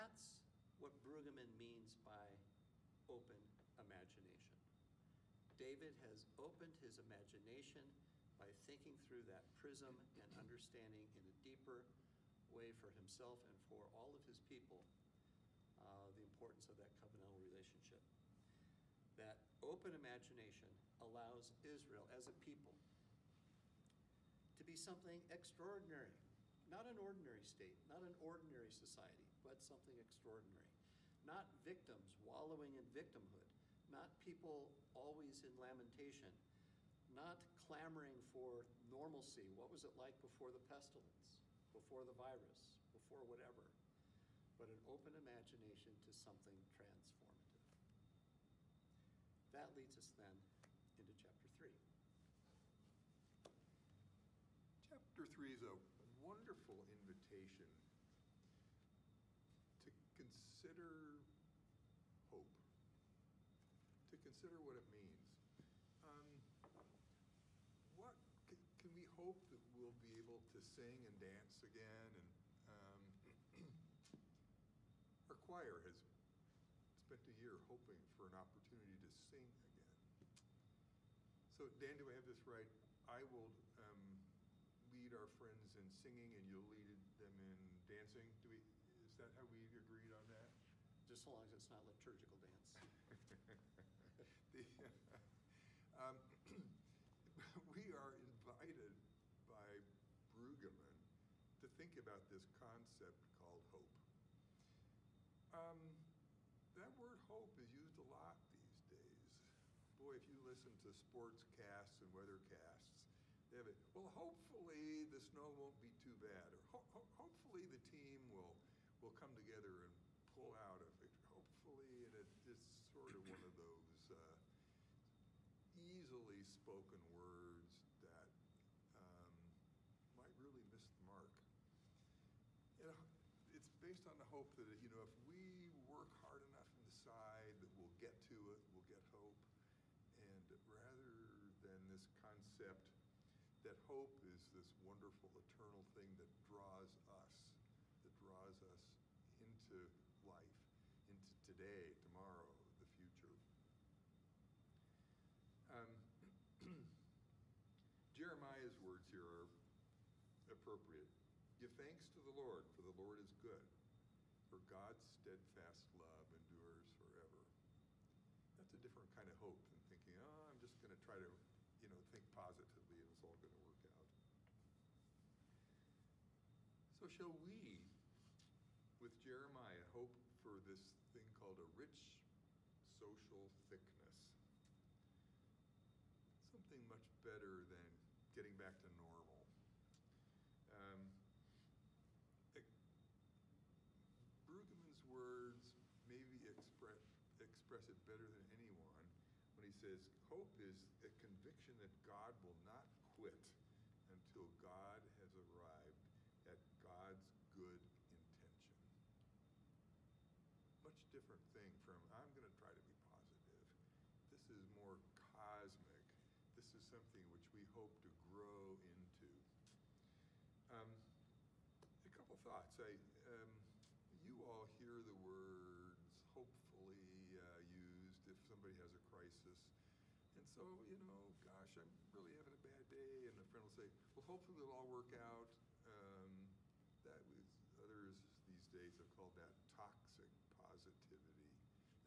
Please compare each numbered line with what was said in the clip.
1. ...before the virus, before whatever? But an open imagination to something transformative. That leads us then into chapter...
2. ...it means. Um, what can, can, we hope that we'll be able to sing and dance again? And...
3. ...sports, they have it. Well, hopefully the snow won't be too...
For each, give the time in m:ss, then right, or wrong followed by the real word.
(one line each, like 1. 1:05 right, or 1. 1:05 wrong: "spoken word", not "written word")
1. 0:41 right
2. 1:04 right
3. 1:52 wrong: "casts", not "sports".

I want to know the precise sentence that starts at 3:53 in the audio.
And a friend will say, well, hopefully it'll all work out.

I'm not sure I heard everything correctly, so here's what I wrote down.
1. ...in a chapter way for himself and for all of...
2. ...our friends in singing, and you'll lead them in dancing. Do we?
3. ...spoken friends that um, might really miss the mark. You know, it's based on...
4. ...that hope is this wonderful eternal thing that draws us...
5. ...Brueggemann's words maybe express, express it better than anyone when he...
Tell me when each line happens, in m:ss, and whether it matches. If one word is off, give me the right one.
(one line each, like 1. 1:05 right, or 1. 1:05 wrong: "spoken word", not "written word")
1. 0:11 wrong: "deeper", not "chapter"
2. 1:25 right
3. 2:06 wrong: "words", not "friends"
4. 2:23 right
5. 3:14 right.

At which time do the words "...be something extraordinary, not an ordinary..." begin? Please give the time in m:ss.
0:24.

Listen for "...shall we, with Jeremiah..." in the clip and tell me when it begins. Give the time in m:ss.
2:57.